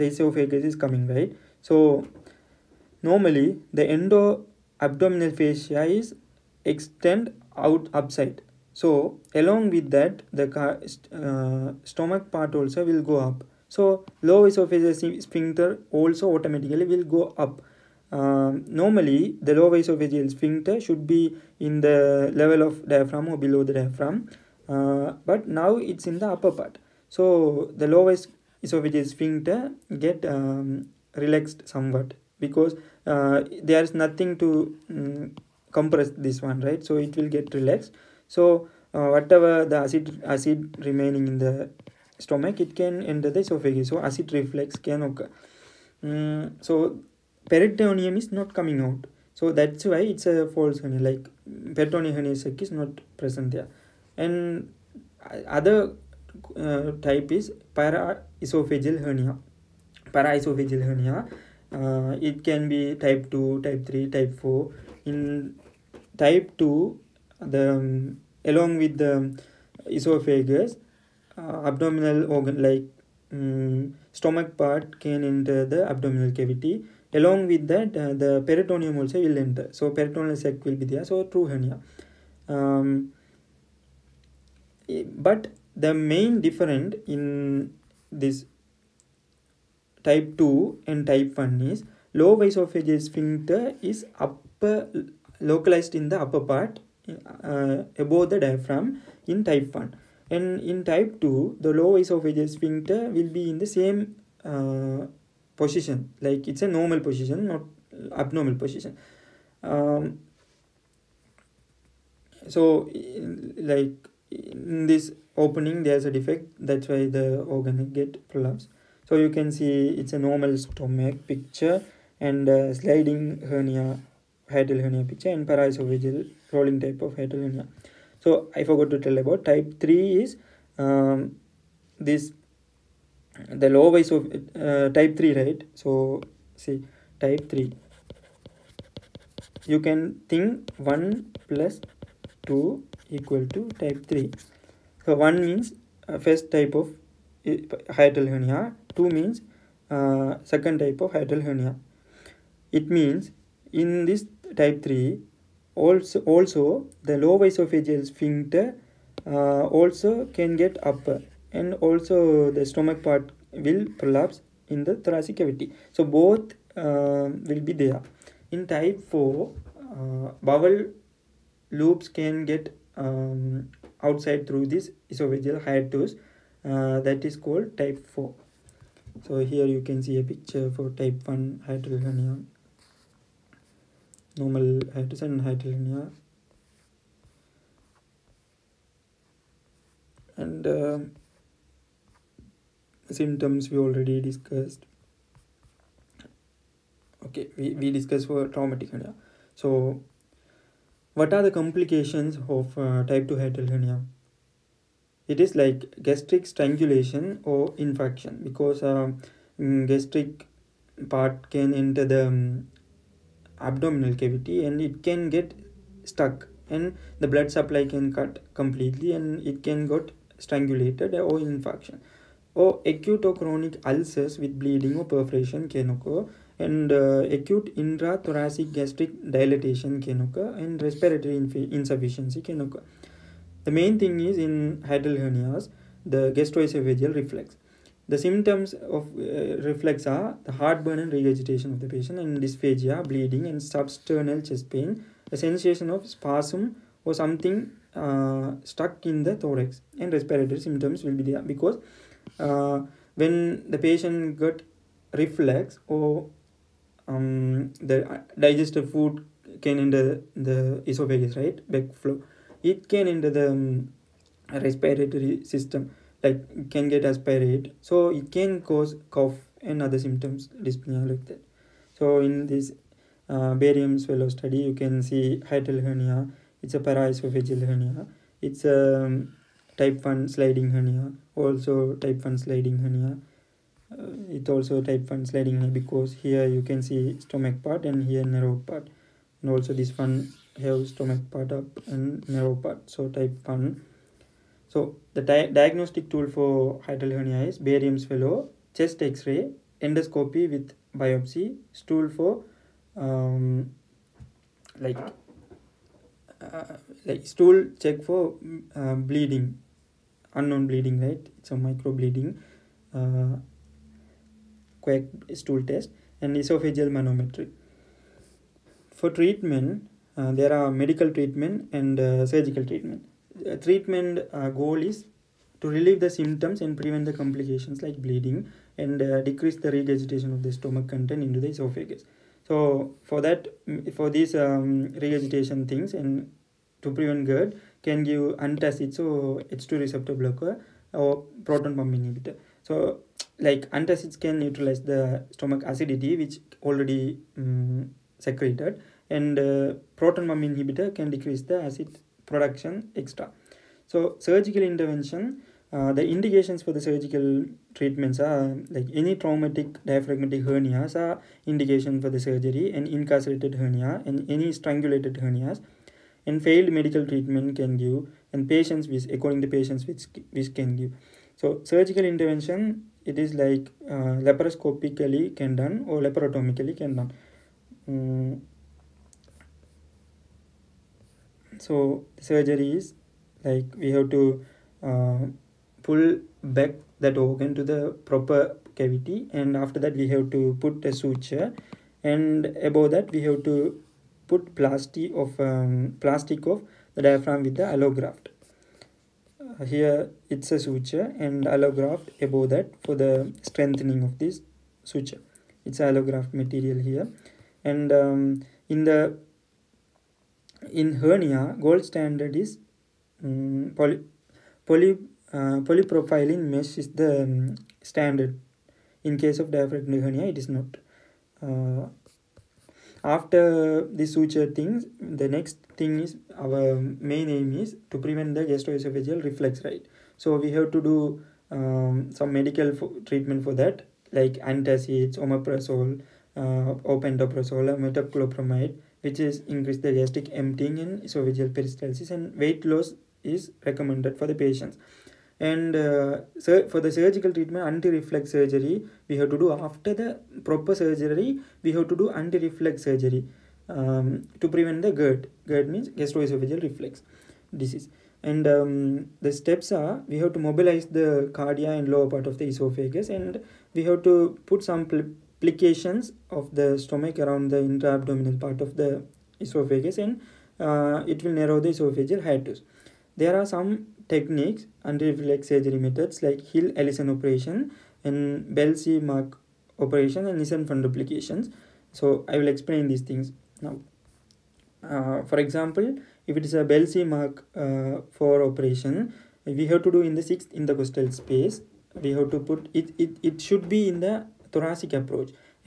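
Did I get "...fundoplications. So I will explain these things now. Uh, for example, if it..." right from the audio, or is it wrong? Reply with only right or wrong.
right.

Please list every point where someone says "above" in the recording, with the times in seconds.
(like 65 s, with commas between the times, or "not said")
98 s, 392 s, 402 s.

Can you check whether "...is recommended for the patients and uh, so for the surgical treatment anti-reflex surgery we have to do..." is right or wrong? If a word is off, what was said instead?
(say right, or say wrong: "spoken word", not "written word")
right.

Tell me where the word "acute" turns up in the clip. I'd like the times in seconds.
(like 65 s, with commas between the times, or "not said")
222 s, 227 s.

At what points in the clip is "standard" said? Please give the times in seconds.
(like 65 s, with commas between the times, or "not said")
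411 s, 417 s.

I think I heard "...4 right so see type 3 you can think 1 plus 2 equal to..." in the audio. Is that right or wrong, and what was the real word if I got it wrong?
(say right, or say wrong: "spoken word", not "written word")
wrong: "3", not "4".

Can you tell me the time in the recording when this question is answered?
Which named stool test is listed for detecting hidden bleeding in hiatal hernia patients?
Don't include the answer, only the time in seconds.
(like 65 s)
314 s.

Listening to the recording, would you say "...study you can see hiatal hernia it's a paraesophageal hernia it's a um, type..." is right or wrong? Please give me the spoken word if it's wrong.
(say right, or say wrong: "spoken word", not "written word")
right.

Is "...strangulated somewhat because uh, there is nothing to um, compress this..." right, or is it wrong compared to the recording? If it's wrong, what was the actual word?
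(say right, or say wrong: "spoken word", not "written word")
wrong: "relaxed", not "strangulated".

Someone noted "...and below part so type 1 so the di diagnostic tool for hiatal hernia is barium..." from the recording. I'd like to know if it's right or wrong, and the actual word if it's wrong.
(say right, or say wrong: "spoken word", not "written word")
wrong: "narrow", not "below".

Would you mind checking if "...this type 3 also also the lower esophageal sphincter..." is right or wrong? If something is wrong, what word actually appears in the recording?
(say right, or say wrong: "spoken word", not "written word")
right.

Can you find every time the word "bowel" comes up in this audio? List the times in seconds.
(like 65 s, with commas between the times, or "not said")
170 s.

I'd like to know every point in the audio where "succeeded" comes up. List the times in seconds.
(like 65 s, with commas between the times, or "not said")
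not said.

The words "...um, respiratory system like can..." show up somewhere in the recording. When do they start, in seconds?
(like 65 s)
263 s.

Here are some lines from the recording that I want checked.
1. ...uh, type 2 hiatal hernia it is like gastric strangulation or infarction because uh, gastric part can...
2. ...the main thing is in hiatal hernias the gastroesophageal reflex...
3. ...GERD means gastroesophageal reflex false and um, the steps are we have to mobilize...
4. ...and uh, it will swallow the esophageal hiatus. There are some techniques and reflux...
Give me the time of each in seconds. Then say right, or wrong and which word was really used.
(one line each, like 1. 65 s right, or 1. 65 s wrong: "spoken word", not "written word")
1. 202 s right
2. 233 s right
3. 455 s wrong: "disease", not "false"
4. 469 s wrong: "narrow", not "swallow".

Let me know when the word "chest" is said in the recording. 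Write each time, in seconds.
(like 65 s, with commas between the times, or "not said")
244 s, 298 s.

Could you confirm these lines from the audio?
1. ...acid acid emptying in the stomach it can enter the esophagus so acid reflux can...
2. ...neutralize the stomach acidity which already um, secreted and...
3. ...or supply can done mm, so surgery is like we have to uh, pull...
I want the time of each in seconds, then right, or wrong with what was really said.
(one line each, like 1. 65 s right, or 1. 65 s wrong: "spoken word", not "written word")
1. 39 s wrong: "remaining", not "emptying"
2. 344 s right
3. 375 s wrong: "laparotomically", not "supply".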